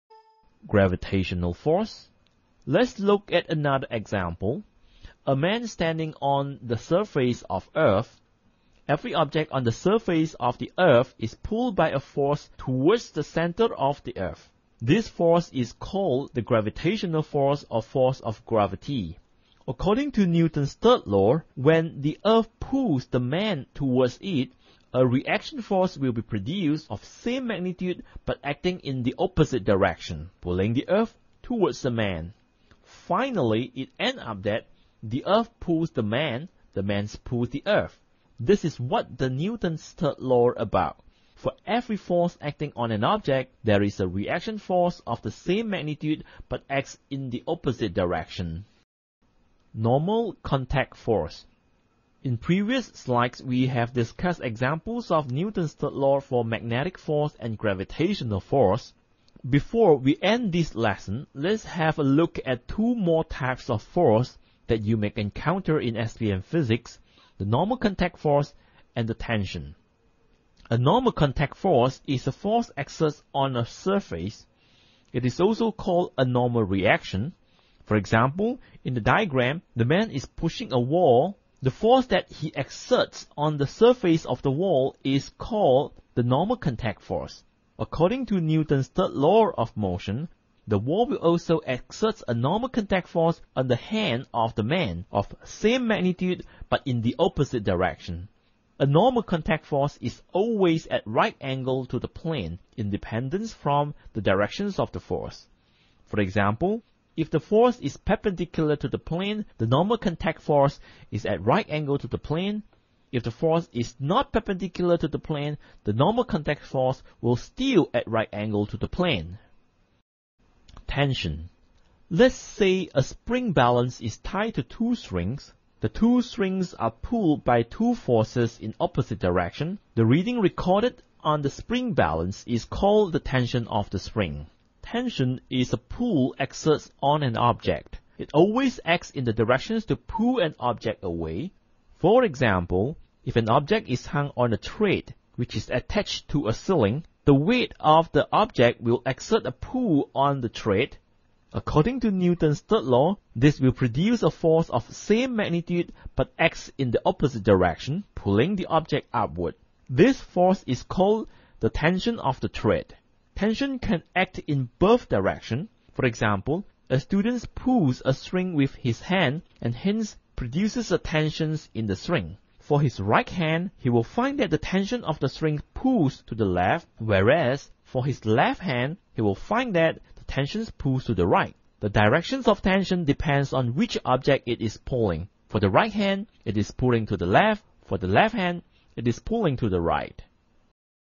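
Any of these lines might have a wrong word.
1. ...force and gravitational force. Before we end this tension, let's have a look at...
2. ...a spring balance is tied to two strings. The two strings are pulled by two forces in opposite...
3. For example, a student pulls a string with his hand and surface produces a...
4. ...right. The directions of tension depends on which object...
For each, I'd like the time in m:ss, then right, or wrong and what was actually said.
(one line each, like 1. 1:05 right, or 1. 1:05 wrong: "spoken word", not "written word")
1. 0:56 wrong: "lesson", not "tension"
2. 2:02 right
3. 2:45 wrong: "hence", not "surface"
4. 3:01 right.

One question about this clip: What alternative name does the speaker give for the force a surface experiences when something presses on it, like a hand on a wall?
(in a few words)
Normal reaction.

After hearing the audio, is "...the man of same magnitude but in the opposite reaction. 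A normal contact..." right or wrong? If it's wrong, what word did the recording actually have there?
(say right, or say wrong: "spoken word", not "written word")
wrong: "direction", not "reaction".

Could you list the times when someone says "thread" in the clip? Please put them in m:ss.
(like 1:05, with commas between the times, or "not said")
2:24, 2:30, 2:42.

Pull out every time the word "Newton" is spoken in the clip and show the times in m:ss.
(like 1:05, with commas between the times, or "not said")
0:20, 0:39, 0:55, 1:28, 2:32.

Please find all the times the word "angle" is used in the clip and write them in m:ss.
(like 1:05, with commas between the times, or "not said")
1:41, 1:51, 1:58.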